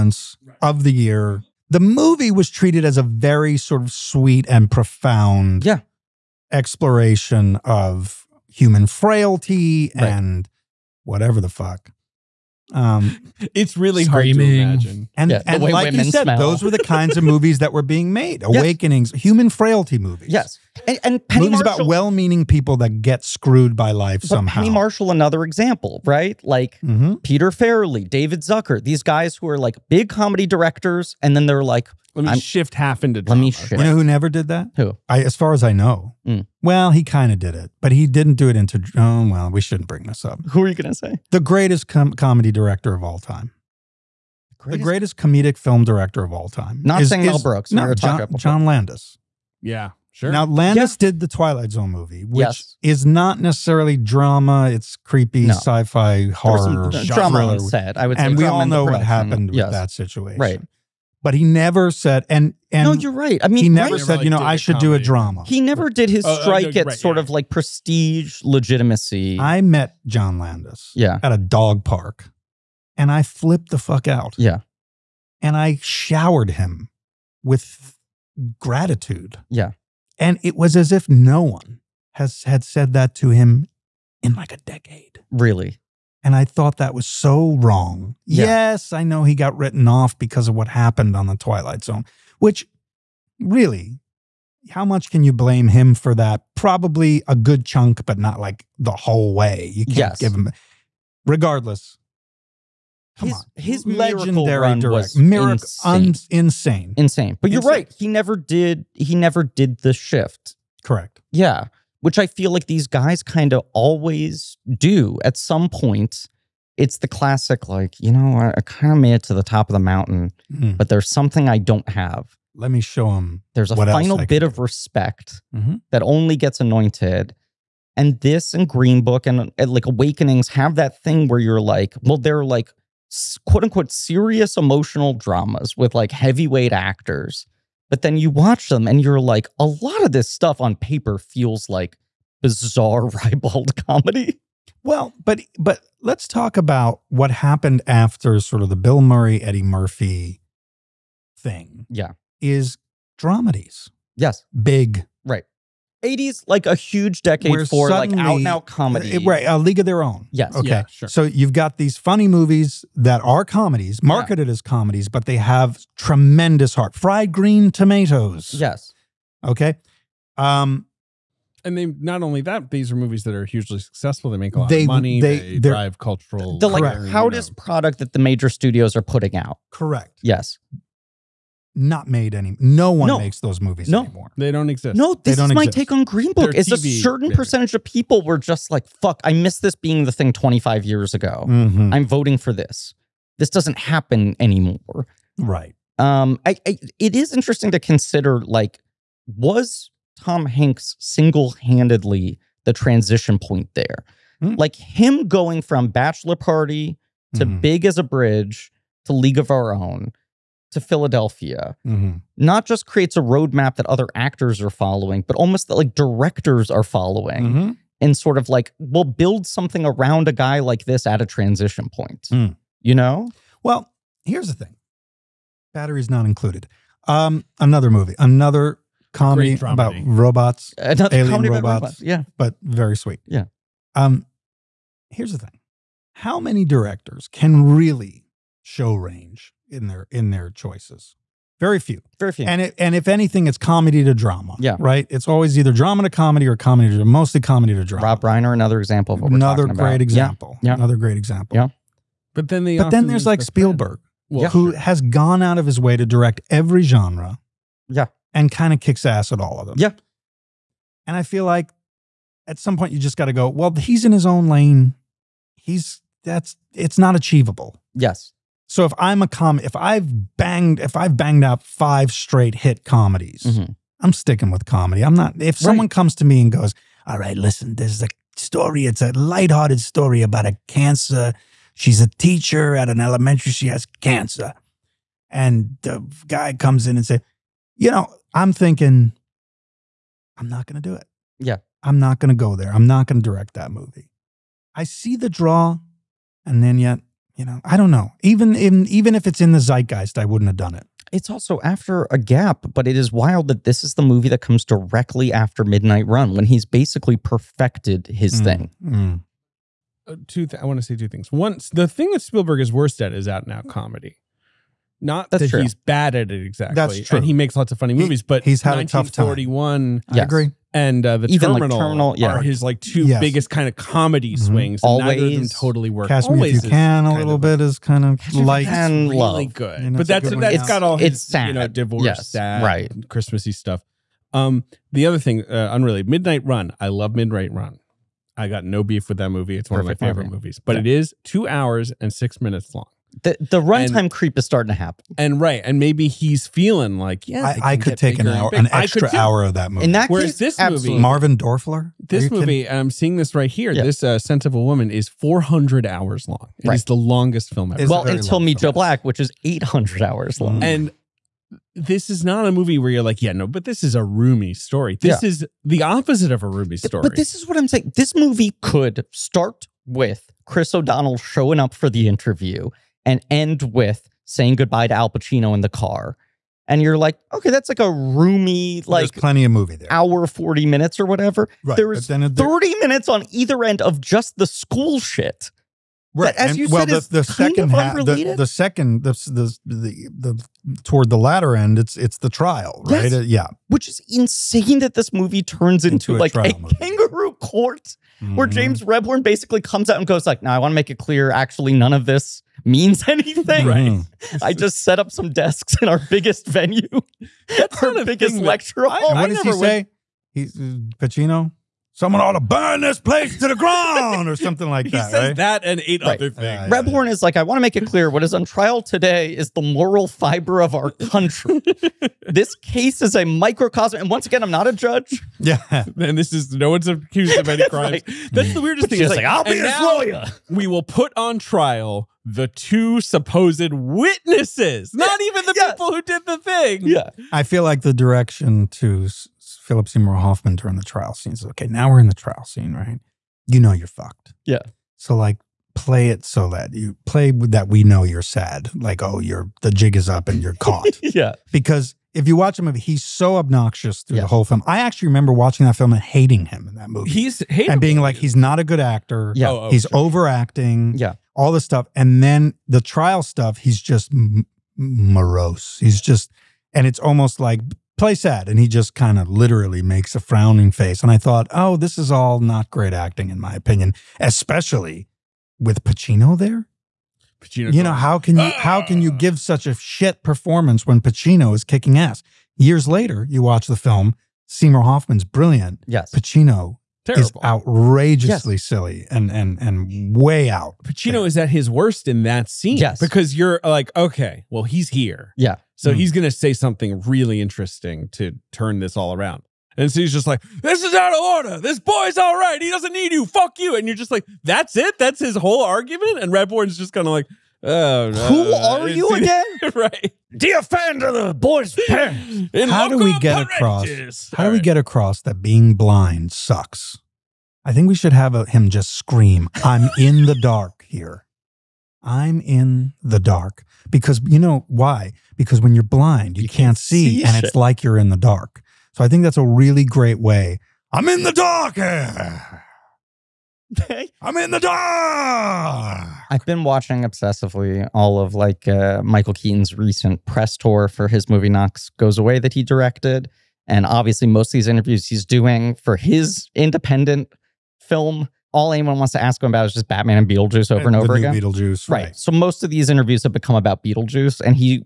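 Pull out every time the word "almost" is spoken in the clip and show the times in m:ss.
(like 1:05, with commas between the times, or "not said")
3:35, 7:46.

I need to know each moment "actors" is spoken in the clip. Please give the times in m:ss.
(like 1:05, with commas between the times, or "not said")
2:16, 3:34, 7:38.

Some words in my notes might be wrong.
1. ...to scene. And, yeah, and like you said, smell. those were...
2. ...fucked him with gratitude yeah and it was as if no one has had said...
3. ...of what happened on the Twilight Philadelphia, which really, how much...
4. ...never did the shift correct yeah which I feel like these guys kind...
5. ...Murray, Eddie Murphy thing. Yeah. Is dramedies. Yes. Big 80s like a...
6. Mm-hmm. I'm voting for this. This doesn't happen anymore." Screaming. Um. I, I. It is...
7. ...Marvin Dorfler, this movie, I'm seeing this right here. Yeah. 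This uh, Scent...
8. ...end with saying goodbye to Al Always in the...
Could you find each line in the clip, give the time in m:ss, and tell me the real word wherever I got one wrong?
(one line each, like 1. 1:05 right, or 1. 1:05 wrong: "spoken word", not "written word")
1. 0:14 wrong: "imagine", not "scene"
2. 1:15 wrong: "showered", not "fucked"
3. 1:30 wrong: "Zone", not "Philadelphia"
4. 1:49 right
5. 2:29 right
6. 3:11 wrong: "Right", not "Screaming"
7. 5:51 right
8. 6:13 wrong: "Pacino", not "Always".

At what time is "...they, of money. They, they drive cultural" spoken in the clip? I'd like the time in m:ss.
2:54.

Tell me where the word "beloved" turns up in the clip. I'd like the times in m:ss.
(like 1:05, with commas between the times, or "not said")
not said.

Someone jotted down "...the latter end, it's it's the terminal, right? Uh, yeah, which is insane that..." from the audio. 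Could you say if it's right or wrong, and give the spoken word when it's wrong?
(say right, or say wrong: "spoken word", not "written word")
wrong: "trial", not "terminal".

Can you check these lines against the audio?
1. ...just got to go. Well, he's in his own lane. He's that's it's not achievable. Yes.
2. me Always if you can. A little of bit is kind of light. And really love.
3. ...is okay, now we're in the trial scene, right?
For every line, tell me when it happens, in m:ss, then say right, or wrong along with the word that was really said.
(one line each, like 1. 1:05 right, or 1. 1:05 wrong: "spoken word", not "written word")
1. 4:22 right
2. 5:26 right
3. 7:21 right.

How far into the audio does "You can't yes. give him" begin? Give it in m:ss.
1:39.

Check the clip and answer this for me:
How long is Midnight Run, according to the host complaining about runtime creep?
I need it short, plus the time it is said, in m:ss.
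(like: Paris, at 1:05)
2 hours and 6 minutes, at 5:41.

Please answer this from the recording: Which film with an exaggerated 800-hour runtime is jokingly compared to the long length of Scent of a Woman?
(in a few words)
Meet Joe Black.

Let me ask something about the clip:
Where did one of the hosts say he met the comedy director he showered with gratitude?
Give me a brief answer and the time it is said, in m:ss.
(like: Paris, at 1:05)
a dog park, at 1:11.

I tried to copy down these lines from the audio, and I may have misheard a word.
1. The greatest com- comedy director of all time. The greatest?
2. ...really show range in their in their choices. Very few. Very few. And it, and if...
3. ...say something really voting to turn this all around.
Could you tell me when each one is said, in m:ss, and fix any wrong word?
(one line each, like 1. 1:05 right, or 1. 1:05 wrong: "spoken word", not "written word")
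1. 0:41 right
2. 3:57 right
3. 8:16 wrong: "interesting", not "voting".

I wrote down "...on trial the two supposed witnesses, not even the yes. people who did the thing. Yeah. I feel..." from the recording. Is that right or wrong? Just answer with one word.
right.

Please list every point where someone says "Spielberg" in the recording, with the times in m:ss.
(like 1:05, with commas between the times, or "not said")
4:13, 5:12.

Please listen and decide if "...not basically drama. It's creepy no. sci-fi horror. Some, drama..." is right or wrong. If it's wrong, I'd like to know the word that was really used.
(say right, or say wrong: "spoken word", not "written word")
wrong: "necessarily", not "basically".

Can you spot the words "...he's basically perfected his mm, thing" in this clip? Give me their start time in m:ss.
5:06.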